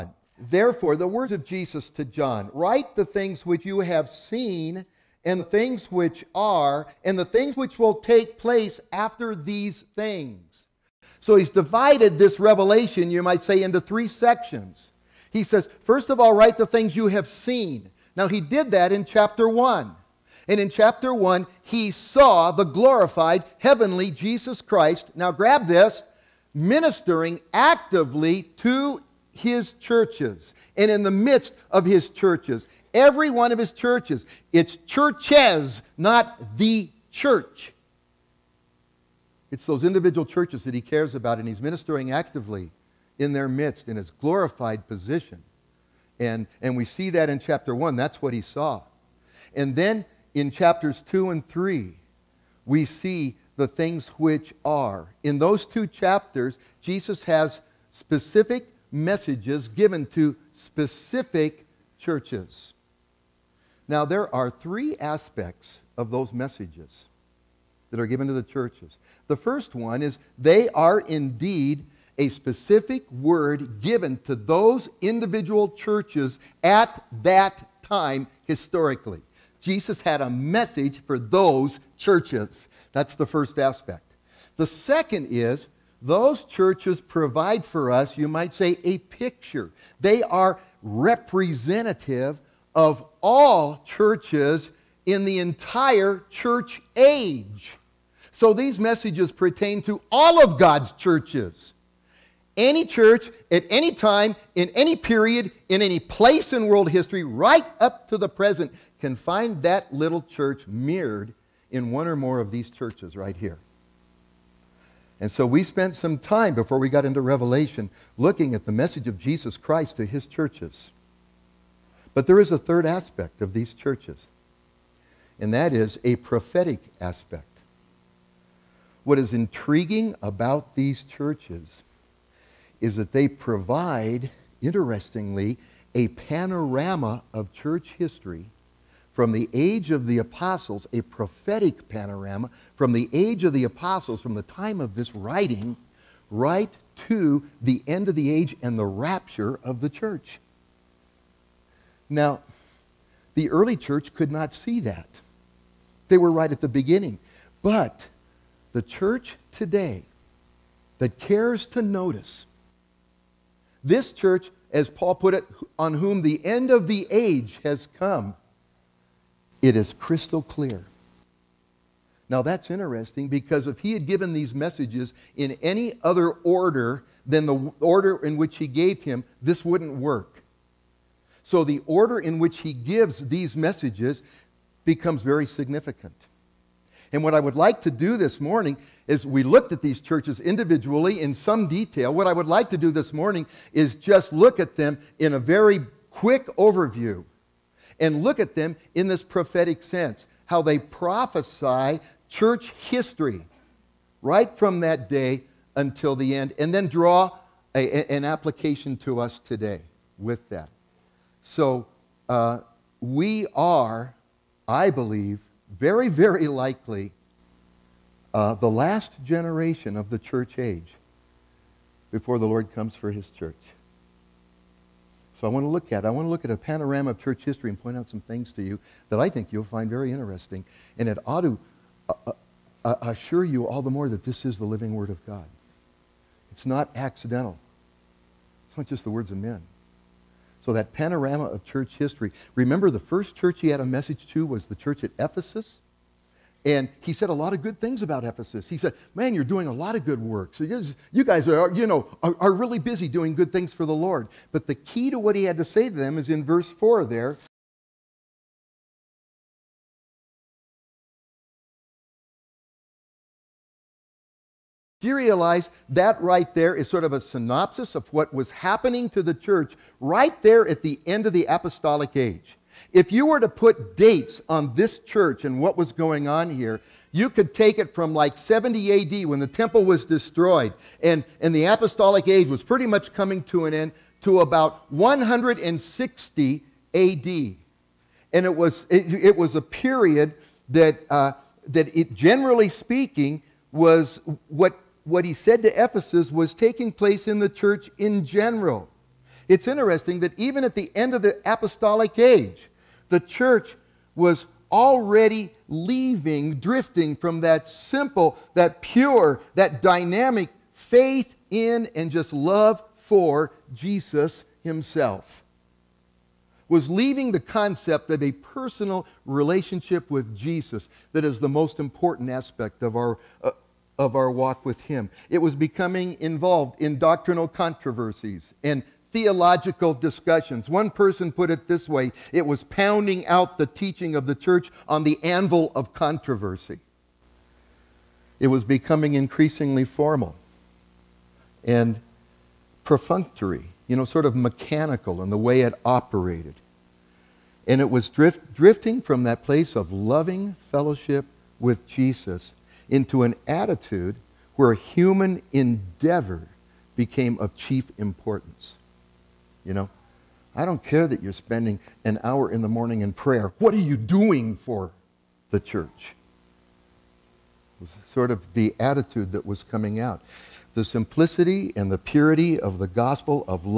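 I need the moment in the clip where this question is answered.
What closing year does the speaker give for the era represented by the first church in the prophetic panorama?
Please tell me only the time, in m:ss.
4:44.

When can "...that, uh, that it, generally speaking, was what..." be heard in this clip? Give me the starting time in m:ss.
4:50.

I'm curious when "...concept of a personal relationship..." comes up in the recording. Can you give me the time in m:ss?
5:17.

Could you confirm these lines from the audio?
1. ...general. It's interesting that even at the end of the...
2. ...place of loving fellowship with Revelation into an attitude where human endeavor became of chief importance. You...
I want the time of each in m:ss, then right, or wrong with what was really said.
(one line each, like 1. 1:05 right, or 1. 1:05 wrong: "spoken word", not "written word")
1. 4:58 right
2. 5:49 wrong: "Jesus", not "Revelation".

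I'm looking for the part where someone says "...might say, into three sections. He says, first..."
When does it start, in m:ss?
0:13.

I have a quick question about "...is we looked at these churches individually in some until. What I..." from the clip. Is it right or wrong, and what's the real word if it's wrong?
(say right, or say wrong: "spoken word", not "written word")
wrong: "detail", not "until".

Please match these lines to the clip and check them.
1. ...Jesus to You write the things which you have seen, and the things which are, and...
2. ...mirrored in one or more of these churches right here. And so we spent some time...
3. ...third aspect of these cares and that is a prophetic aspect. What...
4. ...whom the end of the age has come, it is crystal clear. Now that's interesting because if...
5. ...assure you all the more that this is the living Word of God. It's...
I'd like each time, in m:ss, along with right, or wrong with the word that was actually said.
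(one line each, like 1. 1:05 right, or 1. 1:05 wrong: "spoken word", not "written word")
1. 0:01 wrong: "John", not "You"
2. 1:50 right
3. 2:02 wrong: "churches", not "cares"
4. 2:45 right
5. 3:53 right.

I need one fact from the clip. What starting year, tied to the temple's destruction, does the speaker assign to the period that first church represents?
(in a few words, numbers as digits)
70 AD.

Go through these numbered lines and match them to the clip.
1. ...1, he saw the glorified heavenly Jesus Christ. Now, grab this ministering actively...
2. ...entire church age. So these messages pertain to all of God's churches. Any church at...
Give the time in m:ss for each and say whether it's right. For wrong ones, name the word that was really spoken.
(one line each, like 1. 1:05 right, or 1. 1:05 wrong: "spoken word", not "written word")
1. 0:21 right
2. 1:35 right.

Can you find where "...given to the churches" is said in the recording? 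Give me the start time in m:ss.
1:08.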